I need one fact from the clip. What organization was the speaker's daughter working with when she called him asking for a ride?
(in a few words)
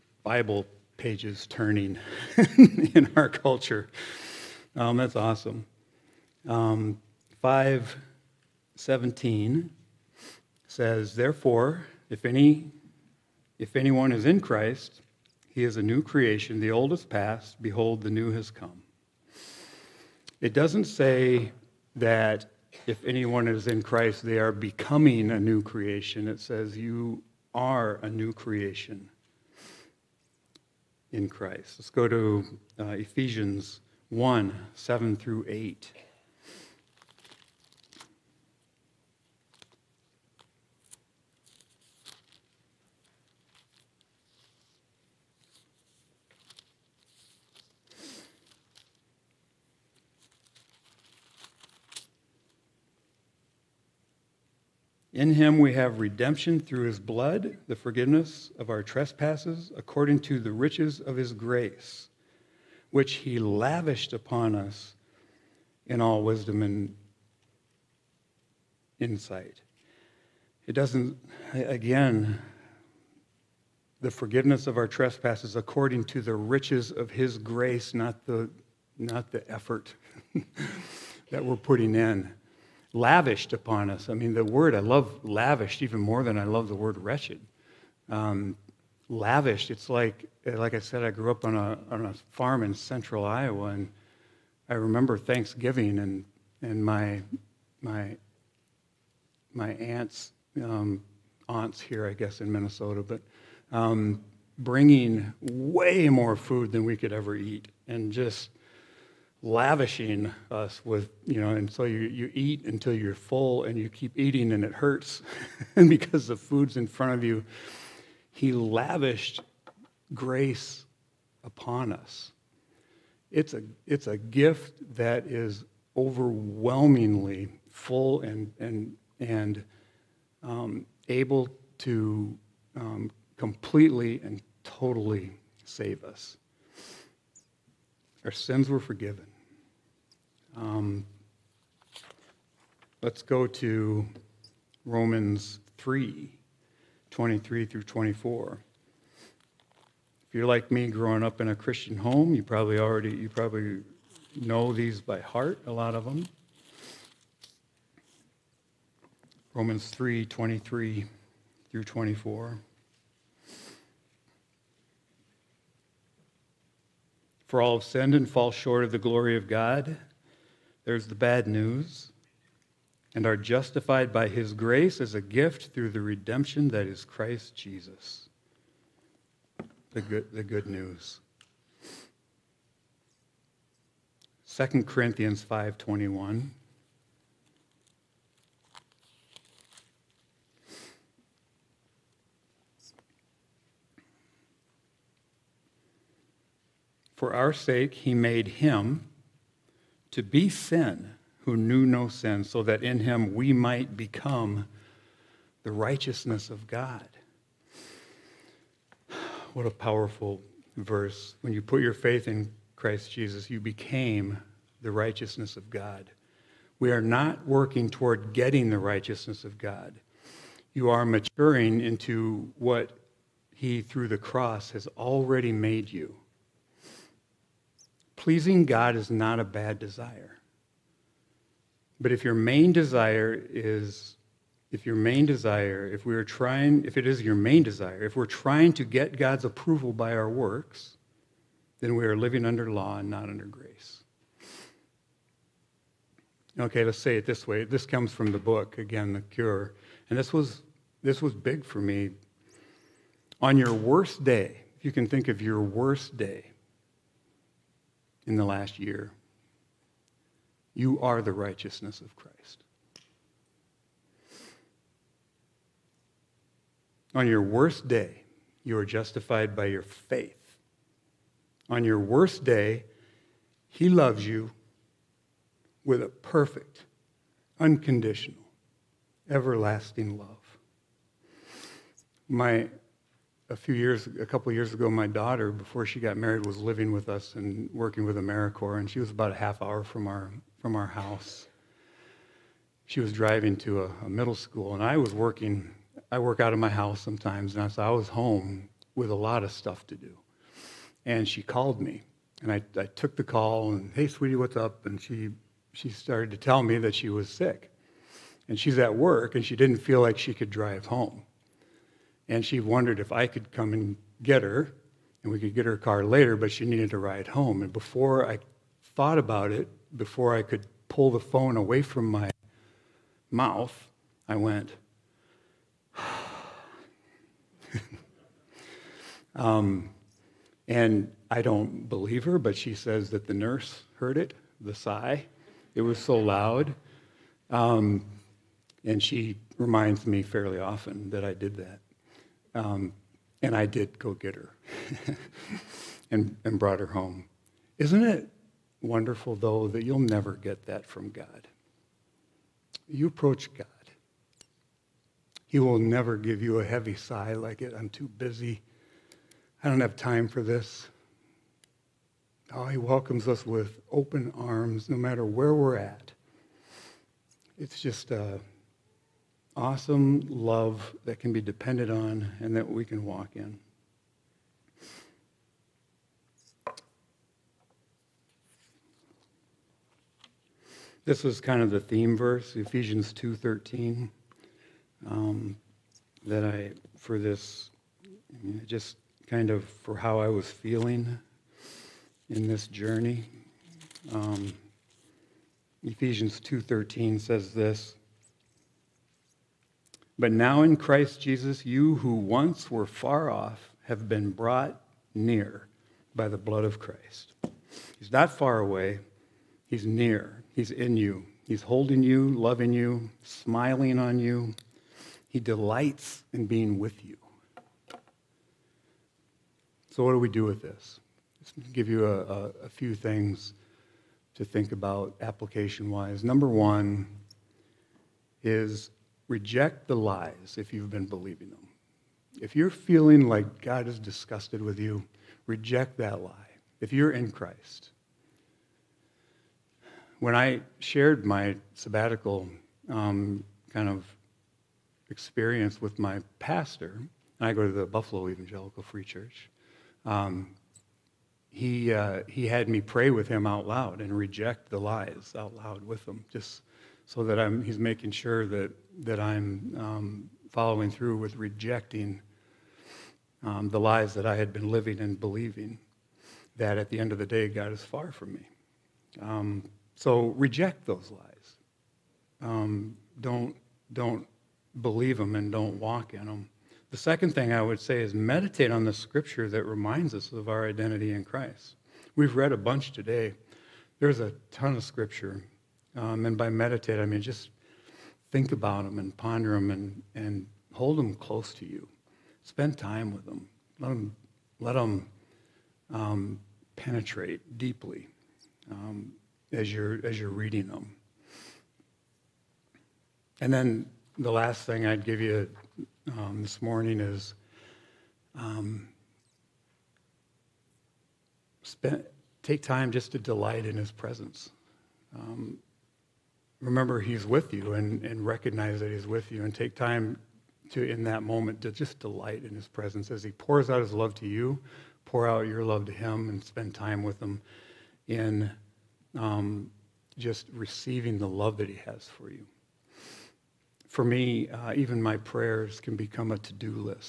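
AmeriCorps.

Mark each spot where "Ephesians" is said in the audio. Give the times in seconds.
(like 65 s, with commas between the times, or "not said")
32 s, 382 s, 395 s.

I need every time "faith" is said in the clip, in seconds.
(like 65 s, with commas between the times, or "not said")
211 s, 269 s.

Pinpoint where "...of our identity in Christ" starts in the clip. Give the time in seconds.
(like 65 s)
480 s.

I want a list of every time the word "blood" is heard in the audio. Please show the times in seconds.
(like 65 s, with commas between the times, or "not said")
56 s, 406 s.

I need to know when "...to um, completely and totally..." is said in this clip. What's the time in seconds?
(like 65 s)
131 s.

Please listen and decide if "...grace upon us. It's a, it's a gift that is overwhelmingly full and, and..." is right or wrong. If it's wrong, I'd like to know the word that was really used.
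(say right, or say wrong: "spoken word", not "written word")
right.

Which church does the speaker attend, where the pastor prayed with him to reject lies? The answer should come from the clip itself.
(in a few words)
Buffalo Evangelical Free Church.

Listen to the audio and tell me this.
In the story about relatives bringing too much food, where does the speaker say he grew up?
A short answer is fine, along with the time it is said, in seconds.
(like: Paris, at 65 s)
farm in central Iowa, at 92 s.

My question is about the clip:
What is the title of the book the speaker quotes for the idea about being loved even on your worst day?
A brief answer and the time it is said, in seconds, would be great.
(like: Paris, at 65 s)
The Cure, at 249 s.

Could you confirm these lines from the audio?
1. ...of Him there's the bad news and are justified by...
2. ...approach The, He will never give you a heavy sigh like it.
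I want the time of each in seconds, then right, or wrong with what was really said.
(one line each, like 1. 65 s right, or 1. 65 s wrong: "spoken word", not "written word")
1. 169 s wrong: "God", not "Him"
2. 353 s wrong: "God", not "The".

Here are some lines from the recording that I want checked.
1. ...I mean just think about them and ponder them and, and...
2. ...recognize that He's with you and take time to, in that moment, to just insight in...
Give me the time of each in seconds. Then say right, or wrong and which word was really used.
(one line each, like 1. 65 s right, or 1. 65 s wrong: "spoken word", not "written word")
1. 486 s right
2. 518 s wrong: "delight", not "insight".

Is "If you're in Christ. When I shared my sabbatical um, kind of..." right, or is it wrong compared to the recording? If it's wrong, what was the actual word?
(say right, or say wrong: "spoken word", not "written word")
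right.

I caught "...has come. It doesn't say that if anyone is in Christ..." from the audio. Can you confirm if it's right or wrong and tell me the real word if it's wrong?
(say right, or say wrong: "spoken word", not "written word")
right.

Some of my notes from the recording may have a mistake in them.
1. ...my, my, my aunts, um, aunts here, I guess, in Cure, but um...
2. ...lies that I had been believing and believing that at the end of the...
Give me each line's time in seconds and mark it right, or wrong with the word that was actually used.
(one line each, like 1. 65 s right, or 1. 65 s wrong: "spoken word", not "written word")
1. 96 s wrong: "Minnesota", not "Cure"
2. 463 s wrong: "living", not "believing".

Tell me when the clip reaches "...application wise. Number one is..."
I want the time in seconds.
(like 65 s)
425 s.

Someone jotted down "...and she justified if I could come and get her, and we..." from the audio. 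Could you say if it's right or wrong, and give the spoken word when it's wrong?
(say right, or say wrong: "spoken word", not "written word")
wrong: "wondered", not "justified".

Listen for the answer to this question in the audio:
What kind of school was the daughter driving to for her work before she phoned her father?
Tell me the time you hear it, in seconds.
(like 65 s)
294 s.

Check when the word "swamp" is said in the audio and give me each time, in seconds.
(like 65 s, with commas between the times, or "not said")
not said.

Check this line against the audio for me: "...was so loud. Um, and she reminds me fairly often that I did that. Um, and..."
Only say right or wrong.
right.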